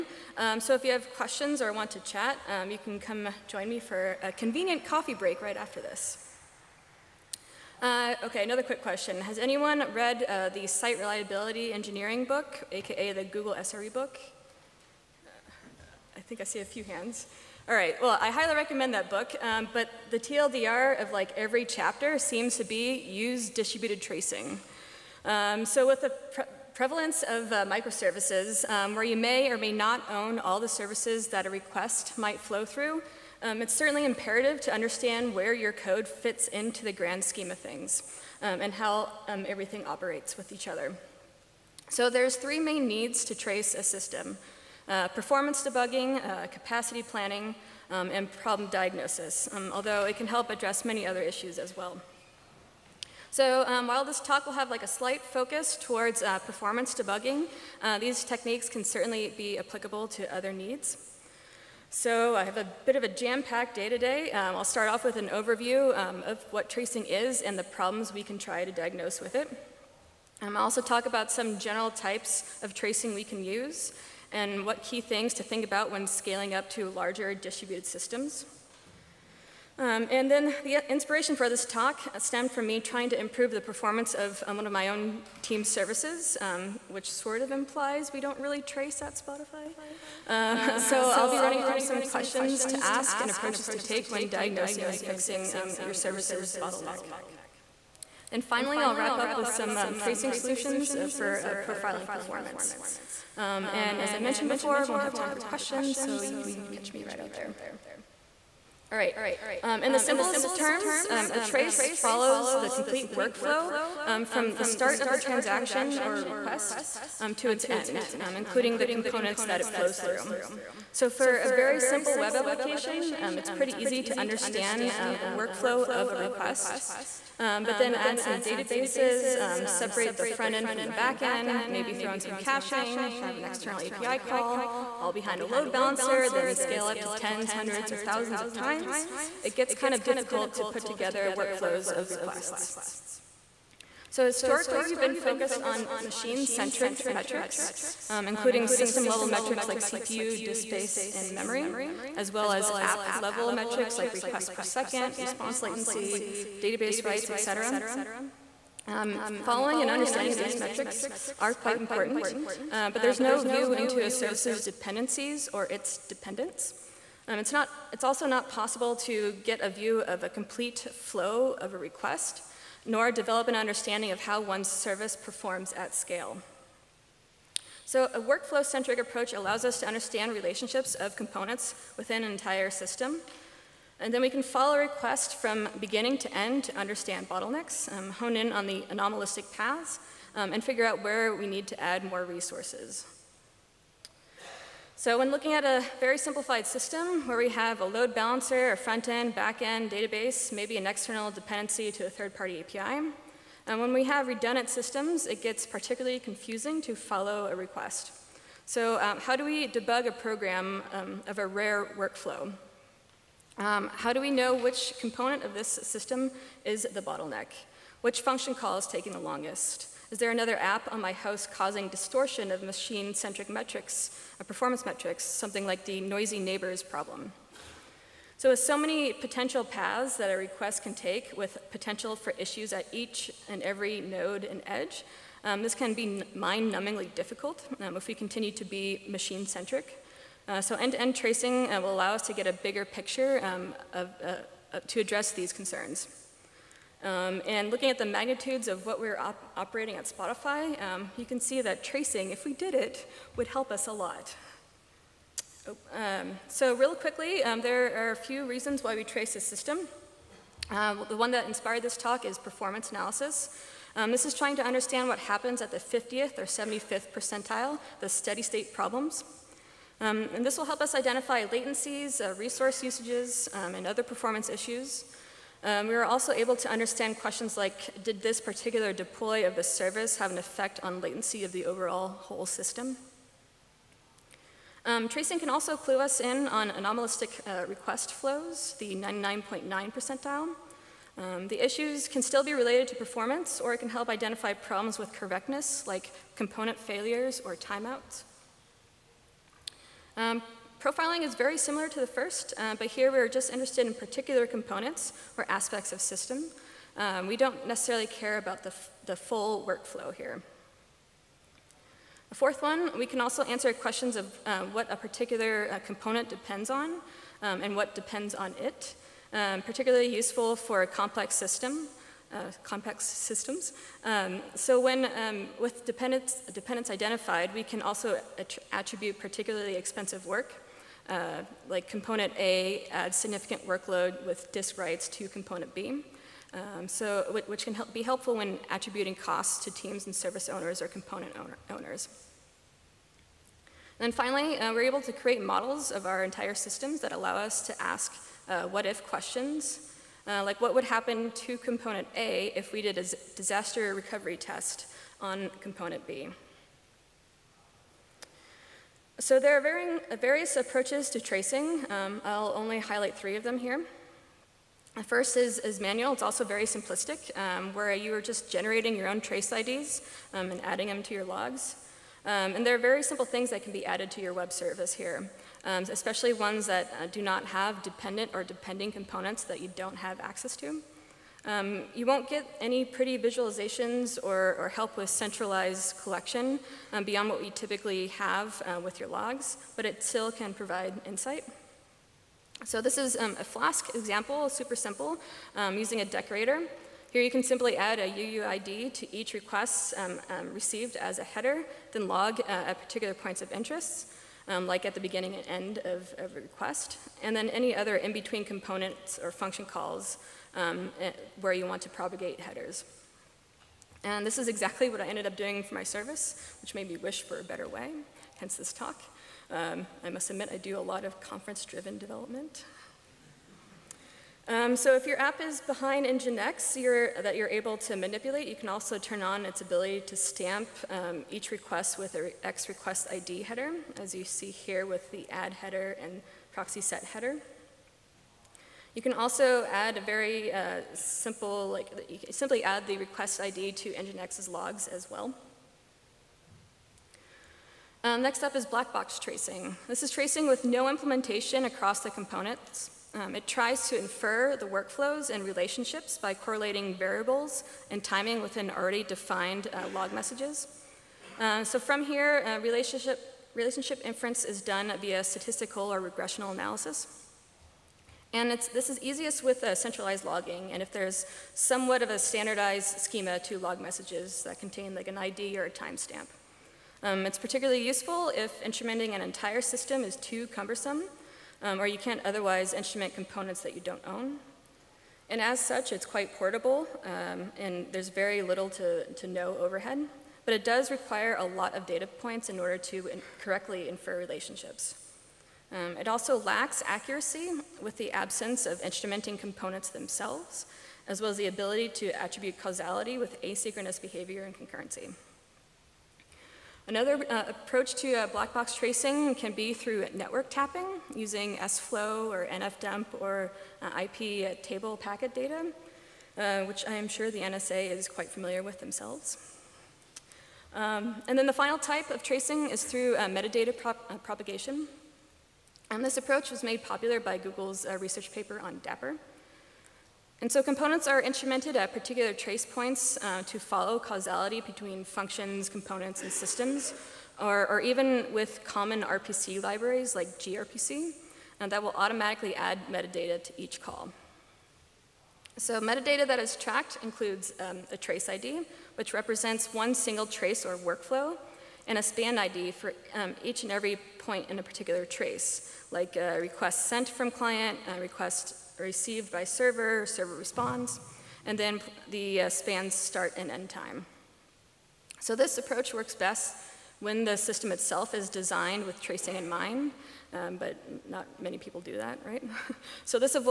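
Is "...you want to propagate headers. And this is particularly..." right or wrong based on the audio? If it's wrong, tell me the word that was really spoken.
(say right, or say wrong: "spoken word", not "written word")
wrong: "exactly", not "particularly".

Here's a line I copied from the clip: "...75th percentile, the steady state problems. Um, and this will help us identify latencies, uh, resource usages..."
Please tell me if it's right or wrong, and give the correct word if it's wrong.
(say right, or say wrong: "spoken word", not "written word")
right.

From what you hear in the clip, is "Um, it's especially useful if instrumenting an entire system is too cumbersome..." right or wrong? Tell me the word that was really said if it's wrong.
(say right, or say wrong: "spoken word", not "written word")
wrong: "particularly", not "especially".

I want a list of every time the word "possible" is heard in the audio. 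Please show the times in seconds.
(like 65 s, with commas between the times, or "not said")
168 s.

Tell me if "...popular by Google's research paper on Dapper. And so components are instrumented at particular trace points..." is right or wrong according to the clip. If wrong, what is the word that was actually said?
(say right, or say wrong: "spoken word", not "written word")
right.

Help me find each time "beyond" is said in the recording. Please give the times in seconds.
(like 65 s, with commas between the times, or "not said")
387 s.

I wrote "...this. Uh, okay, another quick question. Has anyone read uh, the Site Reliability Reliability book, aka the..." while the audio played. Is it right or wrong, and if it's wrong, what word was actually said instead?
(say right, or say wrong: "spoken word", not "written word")
wrong: "Engineering", not "Reliability".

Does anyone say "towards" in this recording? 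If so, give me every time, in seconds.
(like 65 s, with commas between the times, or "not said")
55 s.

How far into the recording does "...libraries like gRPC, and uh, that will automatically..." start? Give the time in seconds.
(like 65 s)
539 s.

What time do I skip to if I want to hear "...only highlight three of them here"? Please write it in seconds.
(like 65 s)
362 s.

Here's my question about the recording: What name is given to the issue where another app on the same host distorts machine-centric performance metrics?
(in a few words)
noisy neighbors problem.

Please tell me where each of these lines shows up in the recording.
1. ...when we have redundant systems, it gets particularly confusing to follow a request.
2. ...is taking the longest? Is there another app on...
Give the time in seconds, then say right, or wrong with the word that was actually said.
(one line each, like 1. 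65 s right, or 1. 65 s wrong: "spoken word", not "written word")
1. 203 s right
2. 218 s right.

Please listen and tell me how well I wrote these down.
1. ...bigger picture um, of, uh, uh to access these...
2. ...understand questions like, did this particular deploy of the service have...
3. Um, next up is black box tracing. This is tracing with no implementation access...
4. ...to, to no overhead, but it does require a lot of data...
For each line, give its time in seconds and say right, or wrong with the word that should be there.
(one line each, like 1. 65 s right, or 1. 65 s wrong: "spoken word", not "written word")
1. 242 s wrong: "address", not "access"
2. 276 s right
3. 448 s wrong: "across", not "access"
4. 488 s right.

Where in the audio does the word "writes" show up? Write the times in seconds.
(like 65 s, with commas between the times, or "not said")
157 s, 334 s.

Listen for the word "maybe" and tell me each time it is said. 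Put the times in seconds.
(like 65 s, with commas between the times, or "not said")
131 s, 200 s.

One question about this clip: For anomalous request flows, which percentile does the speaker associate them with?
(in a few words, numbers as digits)
99.9.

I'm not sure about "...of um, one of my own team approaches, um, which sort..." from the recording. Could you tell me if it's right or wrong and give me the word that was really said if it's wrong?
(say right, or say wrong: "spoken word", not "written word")
wrong: "services", not "approaches".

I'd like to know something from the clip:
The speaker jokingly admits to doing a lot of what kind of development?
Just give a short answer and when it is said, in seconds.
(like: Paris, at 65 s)
conference-driven development, at 421 s.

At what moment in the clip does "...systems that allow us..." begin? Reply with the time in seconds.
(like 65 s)
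346 s.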